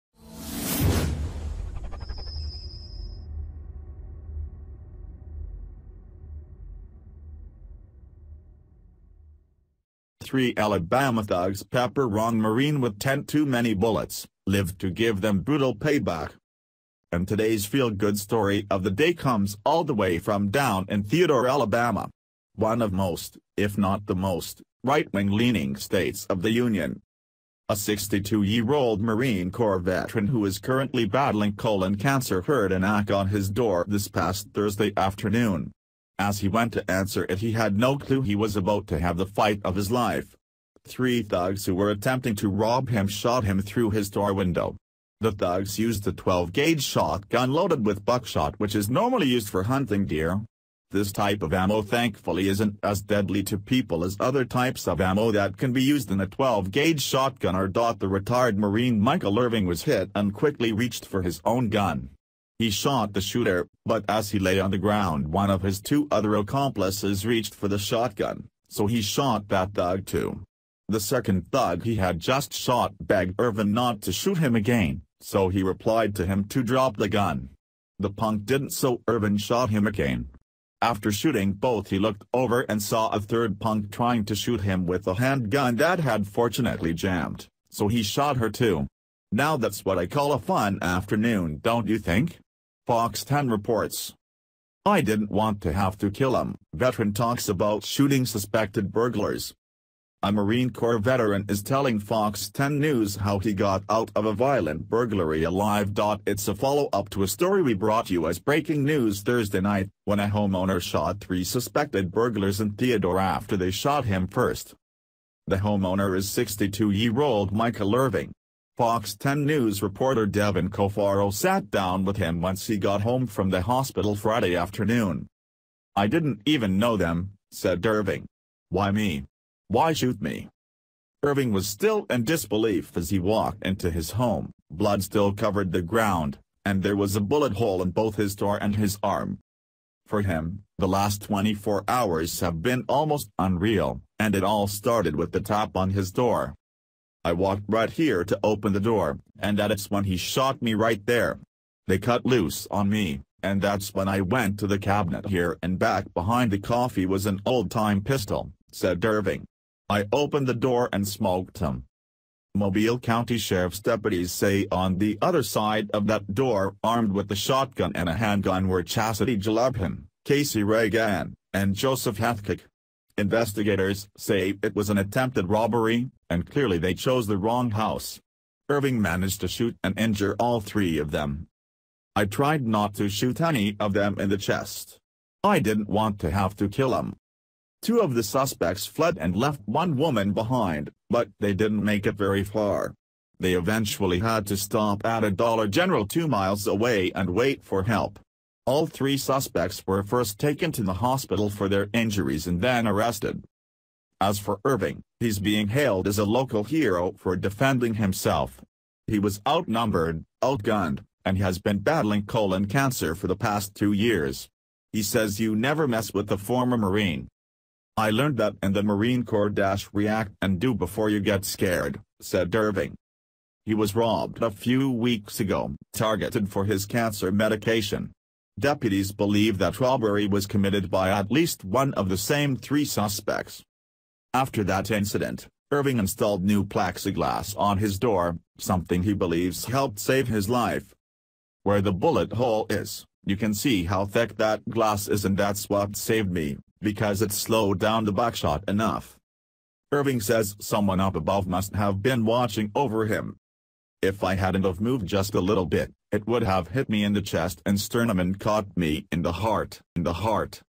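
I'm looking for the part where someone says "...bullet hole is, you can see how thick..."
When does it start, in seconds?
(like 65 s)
241 s.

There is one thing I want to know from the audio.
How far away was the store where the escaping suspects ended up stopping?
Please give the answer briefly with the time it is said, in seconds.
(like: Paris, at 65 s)
2 miles, at 196 s.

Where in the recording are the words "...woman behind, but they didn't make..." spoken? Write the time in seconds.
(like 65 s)
189 s.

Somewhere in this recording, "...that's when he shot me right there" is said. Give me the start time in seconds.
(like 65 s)
149 s.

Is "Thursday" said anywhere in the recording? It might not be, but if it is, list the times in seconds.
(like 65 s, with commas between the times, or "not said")
34 s, 109 s.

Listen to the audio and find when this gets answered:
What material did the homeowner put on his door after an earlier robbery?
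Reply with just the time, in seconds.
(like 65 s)
236 s.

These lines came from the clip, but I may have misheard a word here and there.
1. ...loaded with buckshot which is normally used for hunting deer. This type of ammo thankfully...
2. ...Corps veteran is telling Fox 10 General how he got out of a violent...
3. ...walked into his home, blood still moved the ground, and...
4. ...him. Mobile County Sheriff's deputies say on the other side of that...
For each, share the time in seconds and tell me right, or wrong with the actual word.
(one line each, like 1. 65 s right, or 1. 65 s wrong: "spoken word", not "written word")
1. 47 s right
2. 100 s wrong: "News", not "General"
3. 133 s wrong: "covered", not "moved"
4. 161 s right.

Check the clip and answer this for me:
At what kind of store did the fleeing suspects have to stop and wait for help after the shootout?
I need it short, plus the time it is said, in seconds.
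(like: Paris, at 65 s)
Dollar General, at 195 s.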